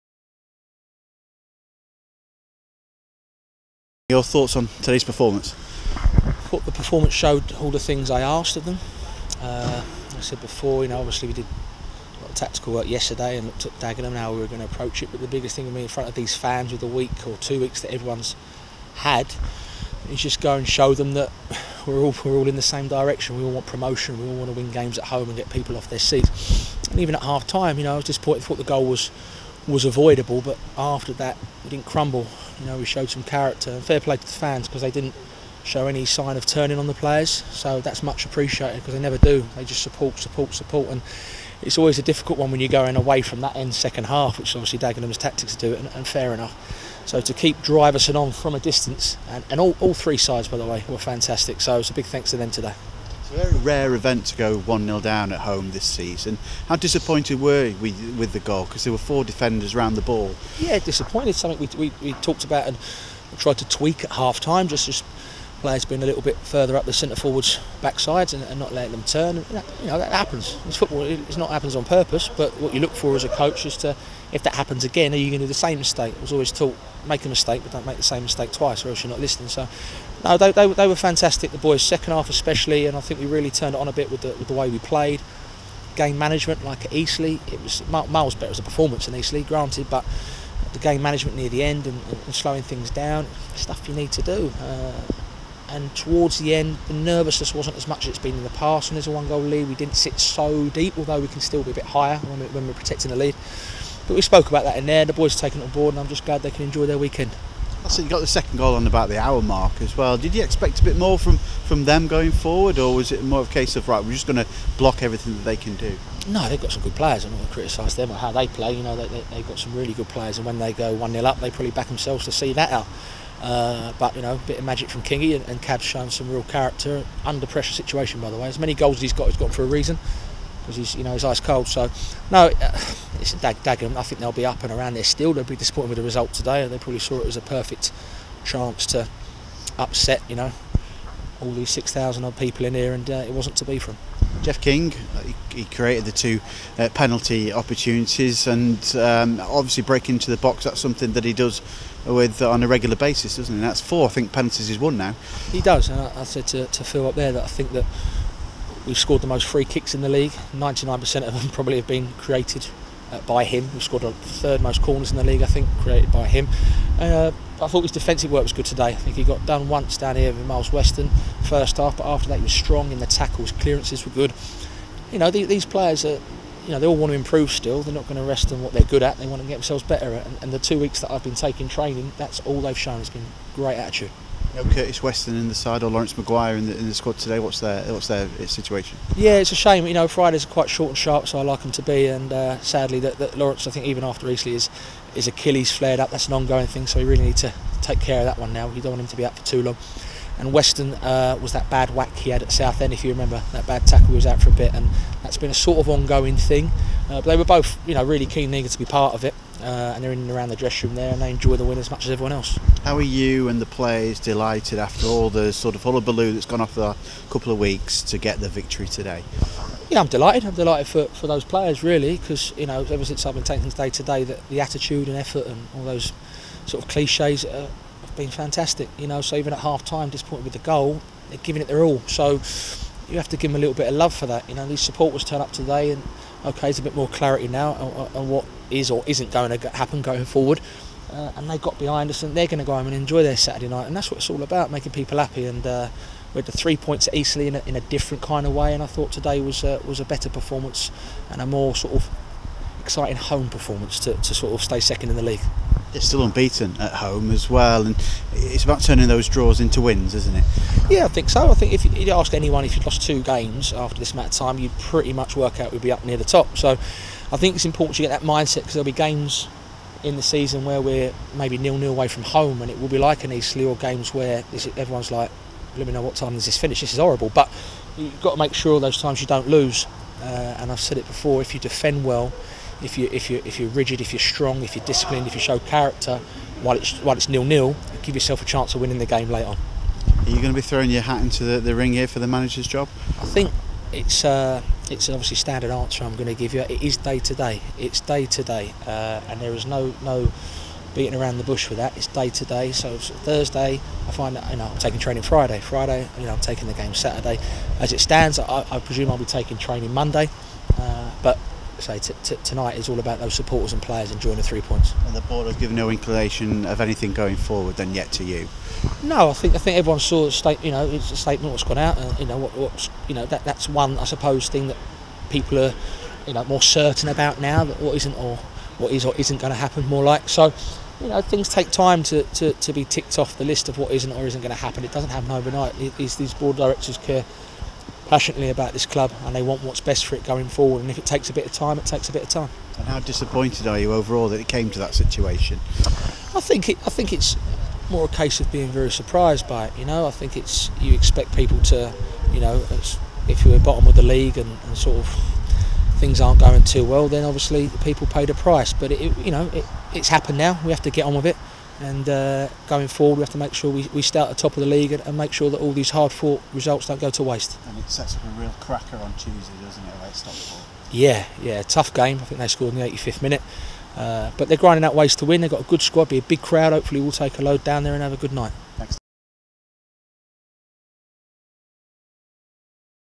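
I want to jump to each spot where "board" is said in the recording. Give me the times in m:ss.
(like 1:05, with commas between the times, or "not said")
1:45, 5:15, 5:36.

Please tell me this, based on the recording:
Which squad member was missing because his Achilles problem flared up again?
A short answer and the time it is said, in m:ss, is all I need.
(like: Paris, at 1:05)
Laurence Maguire, at 3:05.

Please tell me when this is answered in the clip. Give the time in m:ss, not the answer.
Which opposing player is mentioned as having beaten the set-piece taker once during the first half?
2:50.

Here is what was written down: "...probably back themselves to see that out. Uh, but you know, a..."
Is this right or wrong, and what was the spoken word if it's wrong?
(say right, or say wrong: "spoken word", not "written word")
right.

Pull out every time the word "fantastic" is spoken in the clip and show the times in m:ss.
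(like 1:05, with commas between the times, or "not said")
0:50, 1:20, 3:48.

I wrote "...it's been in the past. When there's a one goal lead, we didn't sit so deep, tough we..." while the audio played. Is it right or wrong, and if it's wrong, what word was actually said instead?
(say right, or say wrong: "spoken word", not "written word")
wrong: "although", not "tough".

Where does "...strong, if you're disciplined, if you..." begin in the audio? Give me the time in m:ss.
4:44.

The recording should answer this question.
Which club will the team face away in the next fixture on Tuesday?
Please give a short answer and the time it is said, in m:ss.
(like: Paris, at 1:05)
Stockport, at 6:10.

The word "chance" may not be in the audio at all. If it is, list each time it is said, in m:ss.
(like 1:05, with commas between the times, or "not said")
2:18, 4:48.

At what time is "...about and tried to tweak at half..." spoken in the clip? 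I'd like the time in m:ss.
1:02.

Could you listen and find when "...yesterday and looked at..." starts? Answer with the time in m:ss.
0:12.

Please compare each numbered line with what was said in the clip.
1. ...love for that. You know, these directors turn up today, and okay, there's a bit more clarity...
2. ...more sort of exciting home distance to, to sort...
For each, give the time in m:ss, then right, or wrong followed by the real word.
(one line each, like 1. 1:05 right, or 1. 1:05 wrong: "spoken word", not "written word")
1. 3:53 wrong: "supporters", not "directors"
2. 4:11 wrong: "performance", not "distance".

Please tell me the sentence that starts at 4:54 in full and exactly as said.
Uh, it's obviously standard answer I'm going to give you.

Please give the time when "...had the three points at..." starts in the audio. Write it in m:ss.
4:06.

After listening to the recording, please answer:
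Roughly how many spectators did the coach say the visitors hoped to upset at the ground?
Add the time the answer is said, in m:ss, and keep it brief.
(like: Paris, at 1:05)
6,000, at 2:21.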